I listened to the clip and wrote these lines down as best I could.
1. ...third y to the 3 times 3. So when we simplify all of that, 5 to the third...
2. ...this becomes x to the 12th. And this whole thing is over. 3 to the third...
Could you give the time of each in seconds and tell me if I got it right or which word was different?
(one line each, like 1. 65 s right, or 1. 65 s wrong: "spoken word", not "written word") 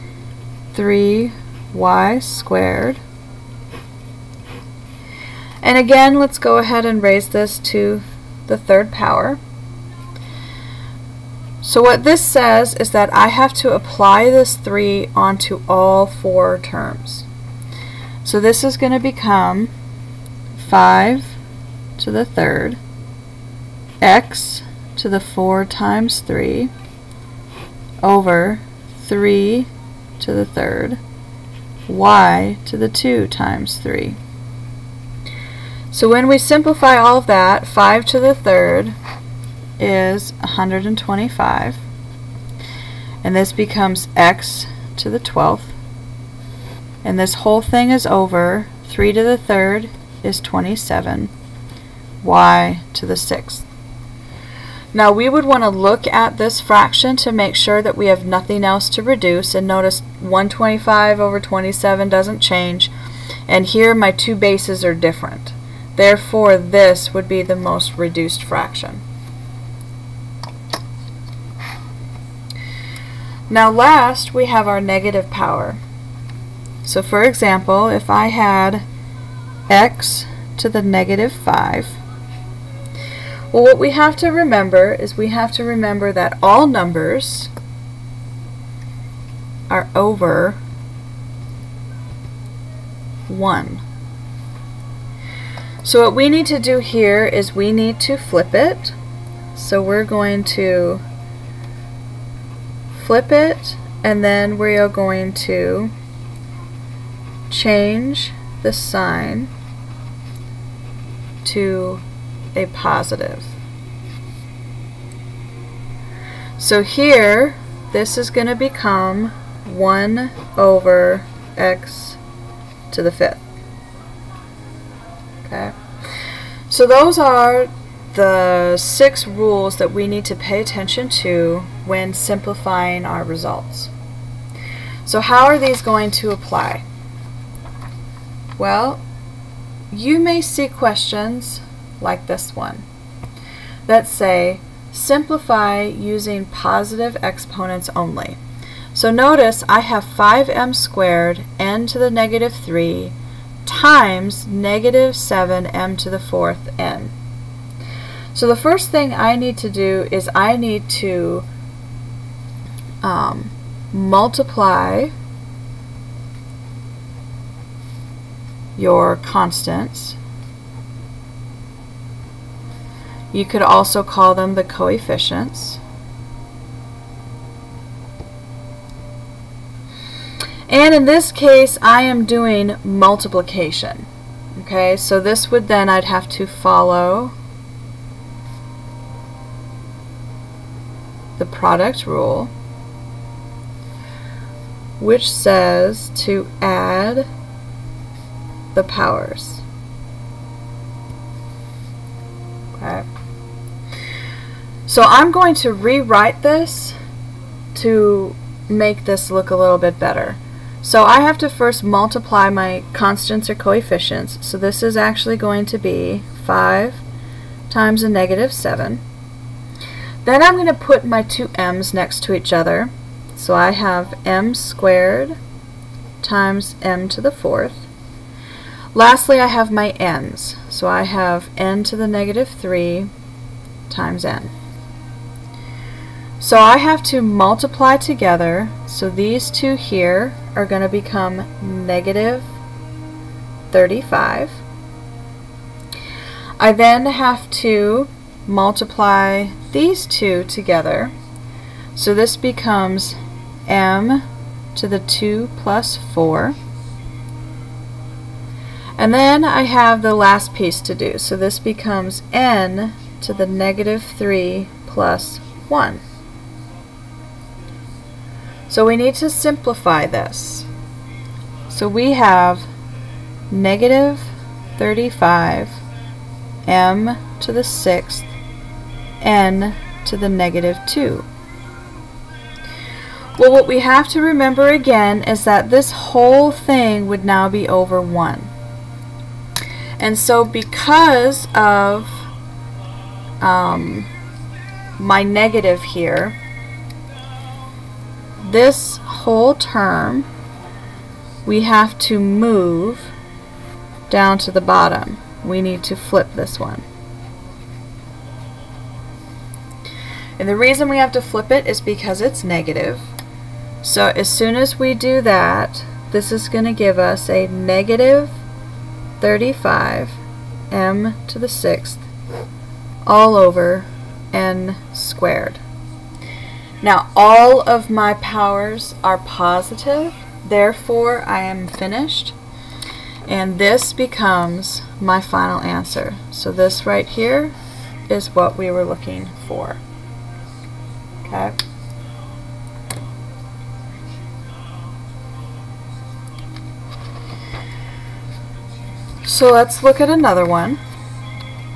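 1. 30 s wrong: "2", not "3"
2. 43 s right.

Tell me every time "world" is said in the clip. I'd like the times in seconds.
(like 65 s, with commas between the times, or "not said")
not said.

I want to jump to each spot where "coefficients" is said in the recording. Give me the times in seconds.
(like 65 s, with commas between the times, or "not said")
174 s, 213 s.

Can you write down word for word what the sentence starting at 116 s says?
So here, this is going to become 1 over x to the fifth.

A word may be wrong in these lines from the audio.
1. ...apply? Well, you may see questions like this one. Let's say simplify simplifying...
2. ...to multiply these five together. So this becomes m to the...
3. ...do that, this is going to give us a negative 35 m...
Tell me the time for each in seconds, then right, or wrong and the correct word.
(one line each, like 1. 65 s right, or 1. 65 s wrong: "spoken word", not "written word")
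1. 136 s wrong: "using", not "simplifying"
2. 247 s wrong: "two", not "five"
3. 314 s right.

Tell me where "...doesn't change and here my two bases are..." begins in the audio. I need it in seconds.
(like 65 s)
62 s.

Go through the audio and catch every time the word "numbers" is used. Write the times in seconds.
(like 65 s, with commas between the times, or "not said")
86 s.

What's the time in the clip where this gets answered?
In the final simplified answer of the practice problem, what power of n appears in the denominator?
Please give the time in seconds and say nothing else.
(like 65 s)
324 s.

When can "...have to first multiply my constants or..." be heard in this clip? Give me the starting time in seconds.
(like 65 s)
211 s.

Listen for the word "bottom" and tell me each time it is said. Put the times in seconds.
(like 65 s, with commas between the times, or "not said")
304 s.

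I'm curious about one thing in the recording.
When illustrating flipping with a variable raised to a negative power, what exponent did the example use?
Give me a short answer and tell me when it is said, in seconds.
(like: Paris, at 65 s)
negative 5, at 79 s.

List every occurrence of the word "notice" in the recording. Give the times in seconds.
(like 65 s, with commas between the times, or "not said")
59 s, 149 s.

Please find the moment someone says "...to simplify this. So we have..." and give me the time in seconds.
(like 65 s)
269 s.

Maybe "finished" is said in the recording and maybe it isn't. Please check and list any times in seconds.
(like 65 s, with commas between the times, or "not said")
331 s.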